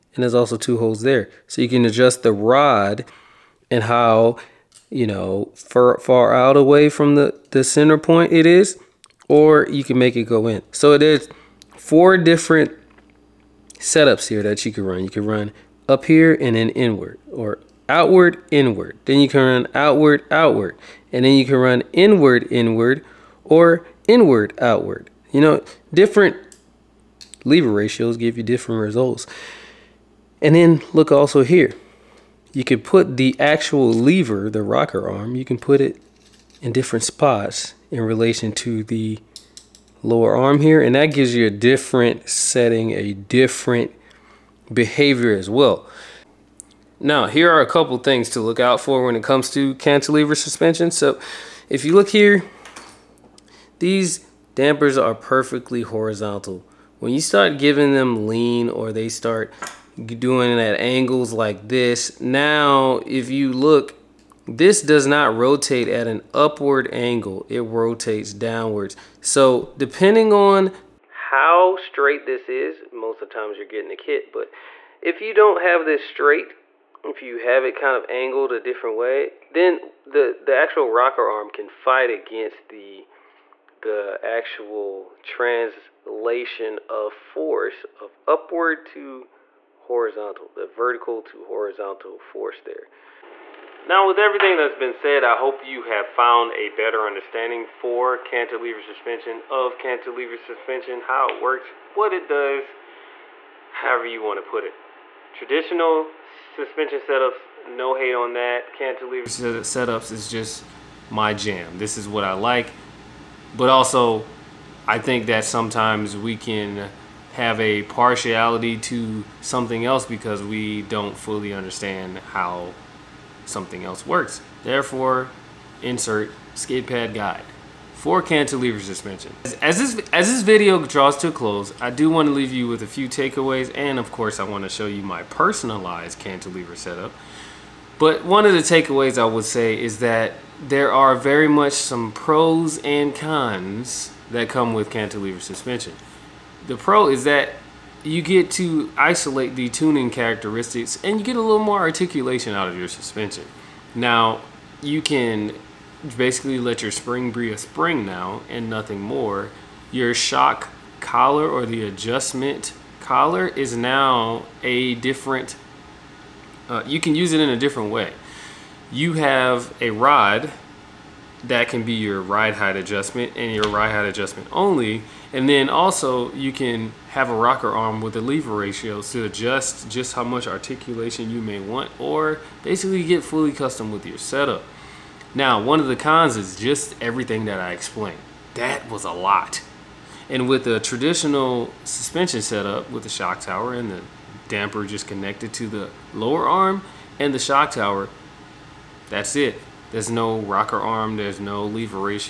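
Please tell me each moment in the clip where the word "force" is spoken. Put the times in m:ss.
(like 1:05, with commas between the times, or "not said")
1:27, 1:32.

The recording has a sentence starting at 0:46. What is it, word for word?
Now, here are a couple things to look out for when it comes to cantilever suspension.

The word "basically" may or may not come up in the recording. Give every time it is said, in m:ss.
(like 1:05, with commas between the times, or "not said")
2:36, 3:02.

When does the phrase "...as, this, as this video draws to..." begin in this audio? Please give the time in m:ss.
2:09.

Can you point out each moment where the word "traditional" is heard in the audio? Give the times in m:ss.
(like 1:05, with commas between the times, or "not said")
1:45, 3:10.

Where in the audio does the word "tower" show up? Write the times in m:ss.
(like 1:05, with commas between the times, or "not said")
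3:13, 3:17.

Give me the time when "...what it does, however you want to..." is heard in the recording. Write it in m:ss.
1:41.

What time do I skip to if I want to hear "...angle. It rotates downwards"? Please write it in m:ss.
1:06.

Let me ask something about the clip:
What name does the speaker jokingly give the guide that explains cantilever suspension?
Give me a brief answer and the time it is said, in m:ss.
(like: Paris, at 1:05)
SkidPad, at 2:06.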